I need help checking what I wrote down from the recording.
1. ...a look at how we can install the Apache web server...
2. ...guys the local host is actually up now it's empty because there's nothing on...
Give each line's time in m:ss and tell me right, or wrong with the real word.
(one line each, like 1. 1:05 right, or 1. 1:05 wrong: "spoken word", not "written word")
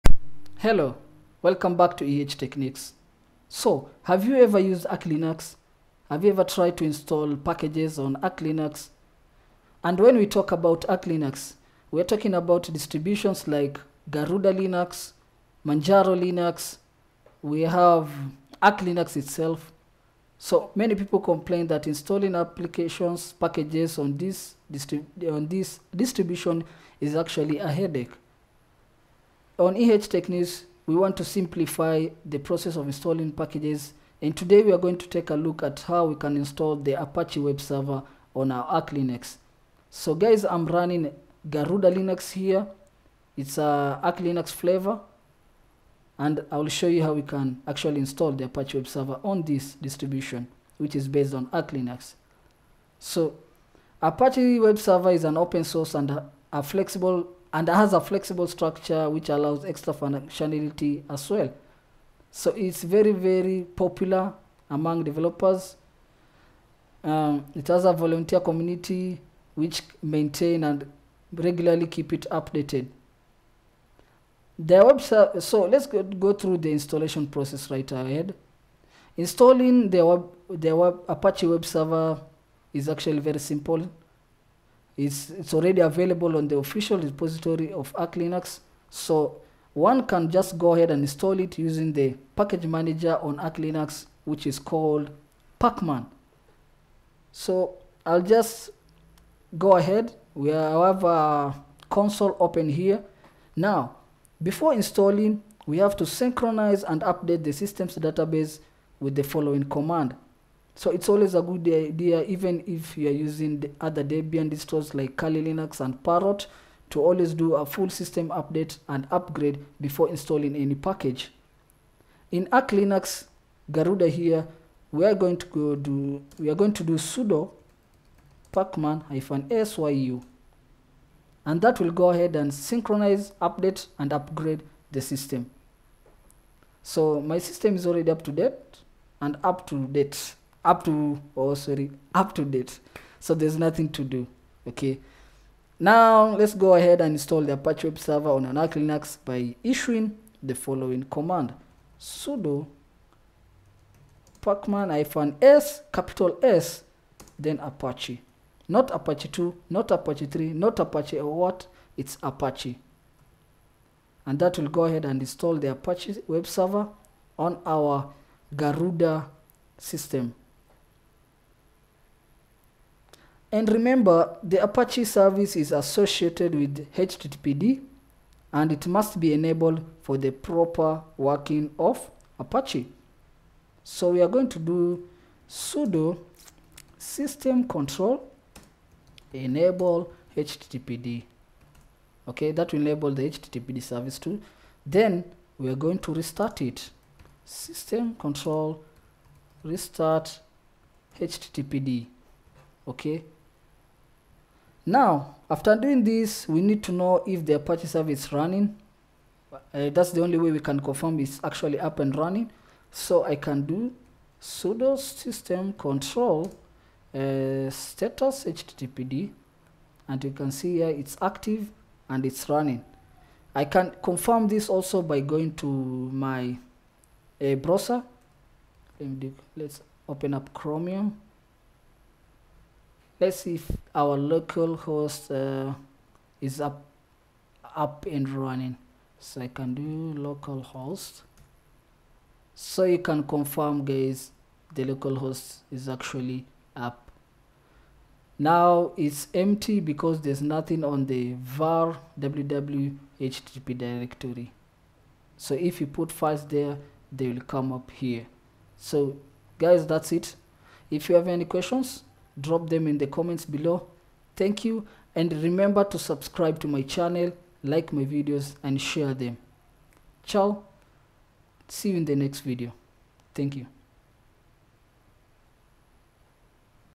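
1. 0:35 right
2. 4:03 right.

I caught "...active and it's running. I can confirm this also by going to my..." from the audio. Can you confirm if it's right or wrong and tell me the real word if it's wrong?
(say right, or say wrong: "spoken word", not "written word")
right.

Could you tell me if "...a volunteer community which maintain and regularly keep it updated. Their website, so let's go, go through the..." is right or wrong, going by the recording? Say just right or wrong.
right.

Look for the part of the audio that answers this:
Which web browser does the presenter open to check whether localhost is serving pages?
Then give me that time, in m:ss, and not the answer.
3:50.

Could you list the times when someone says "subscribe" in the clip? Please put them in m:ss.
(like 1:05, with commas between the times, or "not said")
4:25.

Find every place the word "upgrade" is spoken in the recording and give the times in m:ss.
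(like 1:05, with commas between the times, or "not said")
1:59, 2:14.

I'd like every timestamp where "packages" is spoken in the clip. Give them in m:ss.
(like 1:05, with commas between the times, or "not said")
0:07, 0:23, 0:33, 1:32, 2:00.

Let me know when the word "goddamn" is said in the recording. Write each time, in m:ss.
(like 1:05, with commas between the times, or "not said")
not said.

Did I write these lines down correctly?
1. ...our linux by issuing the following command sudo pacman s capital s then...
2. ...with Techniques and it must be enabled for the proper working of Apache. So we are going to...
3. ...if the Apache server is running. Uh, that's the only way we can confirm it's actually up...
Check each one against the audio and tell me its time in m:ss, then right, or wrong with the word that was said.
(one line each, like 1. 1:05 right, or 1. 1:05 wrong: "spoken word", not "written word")
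1. 2:28 right
2. 2:56 wrong: "HTTPD", not "Techniques"
3. 3:27 right.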